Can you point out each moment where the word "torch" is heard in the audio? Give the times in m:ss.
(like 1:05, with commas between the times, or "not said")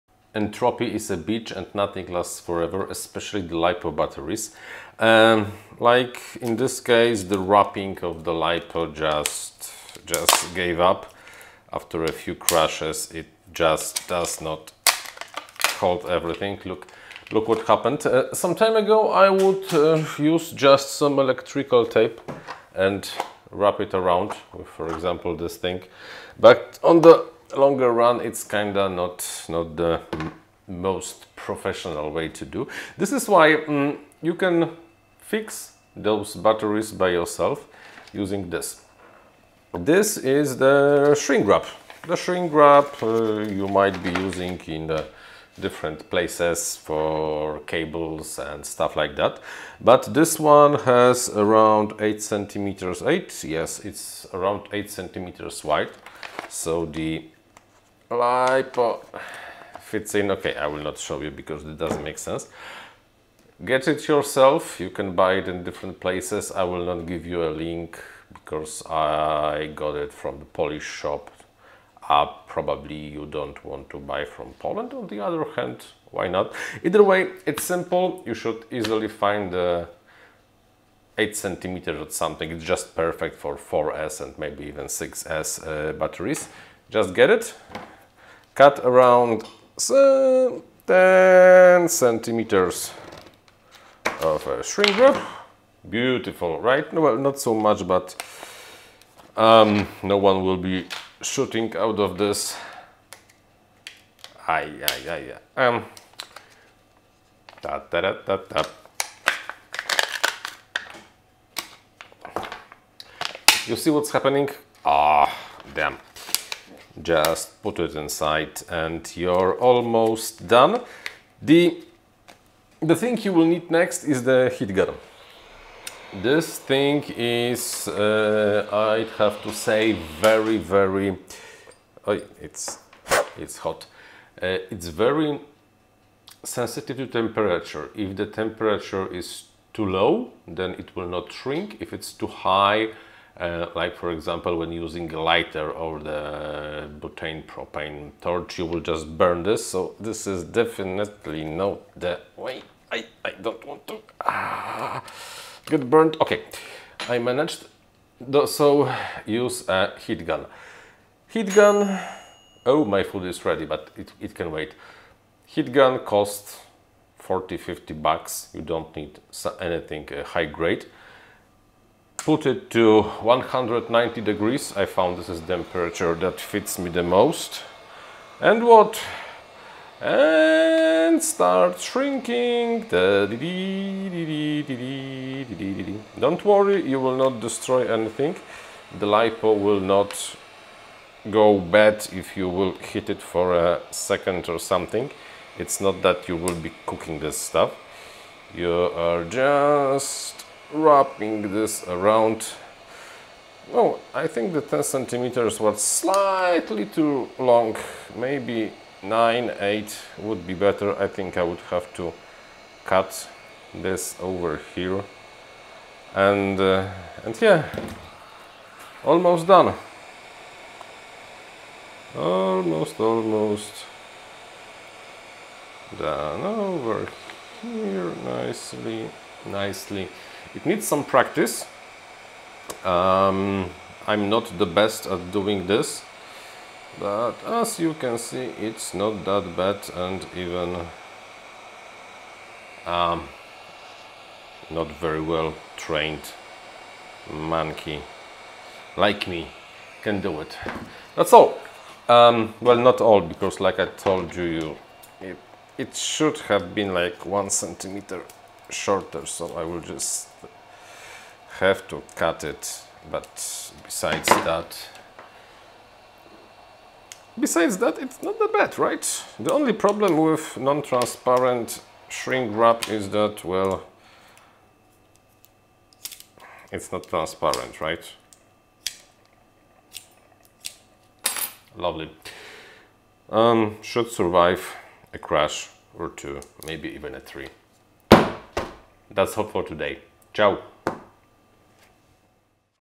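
2:28.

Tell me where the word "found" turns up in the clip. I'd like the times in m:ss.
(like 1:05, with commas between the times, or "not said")
2:54.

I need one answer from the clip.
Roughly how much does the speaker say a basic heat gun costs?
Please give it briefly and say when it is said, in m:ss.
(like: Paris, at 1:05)
40-50 bucks, at 2:47.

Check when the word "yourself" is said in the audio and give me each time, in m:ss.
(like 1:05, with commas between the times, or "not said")
0:37, 1:04.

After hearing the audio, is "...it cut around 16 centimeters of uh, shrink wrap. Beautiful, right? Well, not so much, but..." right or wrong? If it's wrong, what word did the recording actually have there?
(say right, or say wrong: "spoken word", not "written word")
wrong: "10", not "16".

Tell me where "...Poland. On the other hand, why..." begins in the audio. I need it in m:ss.
1:14.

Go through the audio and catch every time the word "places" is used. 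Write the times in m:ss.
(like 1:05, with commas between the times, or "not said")
0:46, 1:06.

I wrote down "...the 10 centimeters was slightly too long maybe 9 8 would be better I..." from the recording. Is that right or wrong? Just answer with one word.
right.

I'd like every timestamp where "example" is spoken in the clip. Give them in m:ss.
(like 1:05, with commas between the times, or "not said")
0:24, 2:24.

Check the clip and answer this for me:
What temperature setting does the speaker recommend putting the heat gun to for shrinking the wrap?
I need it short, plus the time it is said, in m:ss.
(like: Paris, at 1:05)
190 degrees, at 2:53.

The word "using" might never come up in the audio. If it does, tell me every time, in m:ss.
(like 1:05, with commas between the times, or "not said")
0:38, 0:44, 2:24.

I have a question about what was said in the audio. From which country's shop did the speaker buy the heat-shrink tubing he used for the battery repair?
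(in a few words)
Poland.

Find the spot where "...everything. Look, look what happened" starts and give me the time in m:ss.
0:16.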